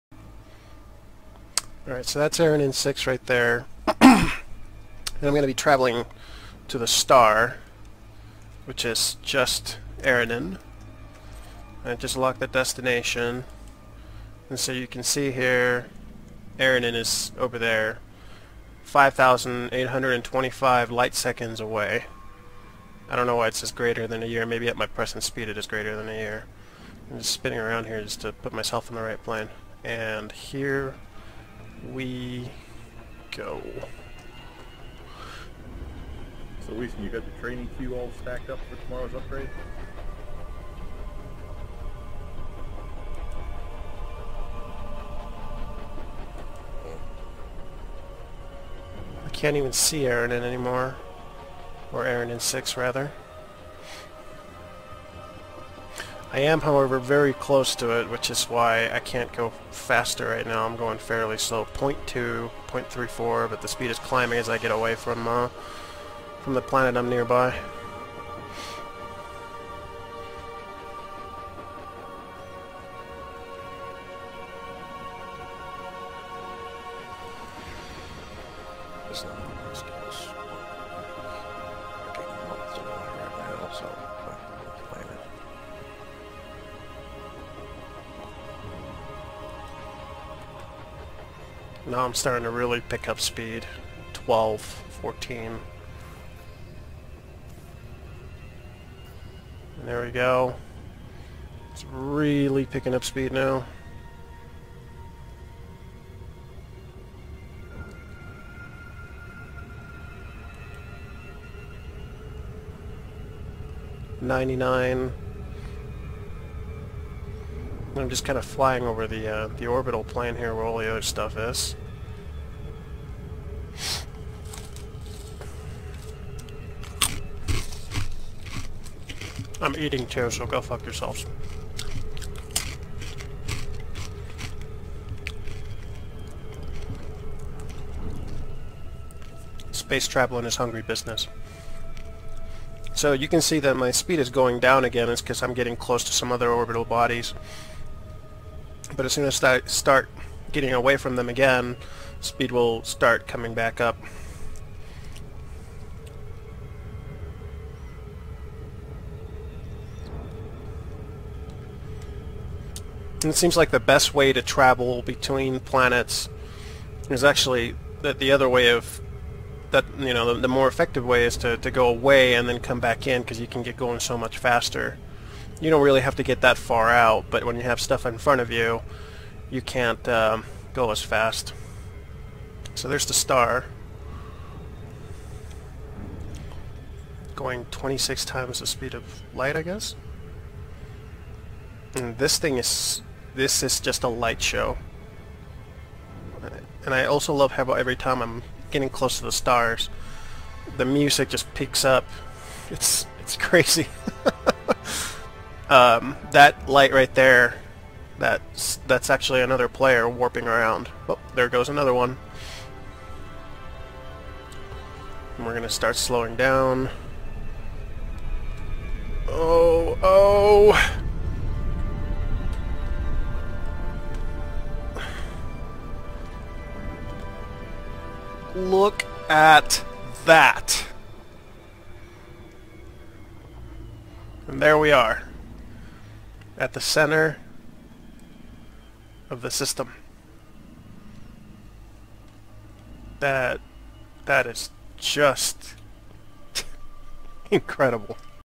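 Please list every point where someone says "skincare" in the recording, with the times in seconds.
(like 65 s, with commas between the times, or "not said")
not said.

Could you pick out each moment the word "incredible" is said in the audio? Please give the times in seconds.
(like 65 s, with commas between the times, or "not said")
247 s.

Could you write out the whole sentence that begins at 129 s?
I'm eating too, so go fuck yourselves.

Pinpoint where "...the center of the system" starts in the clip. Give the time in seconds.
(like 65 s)
236 s.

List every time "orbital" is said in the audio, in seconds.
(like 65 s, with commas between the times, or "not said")
119 s, 146 s.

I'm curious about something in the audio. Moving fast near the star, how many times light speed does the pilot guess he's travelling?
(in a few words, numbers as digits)
26 times.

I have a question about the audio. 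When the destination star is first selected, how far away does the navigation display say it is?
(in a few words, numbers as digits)
5,825 light seconds.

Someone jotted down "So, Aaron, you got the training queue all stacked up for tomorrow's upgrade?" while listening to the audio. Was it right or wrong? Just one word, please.
wrong.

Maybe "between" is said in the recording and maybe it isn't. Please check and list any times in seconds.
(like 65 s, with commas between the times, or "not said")
165 s.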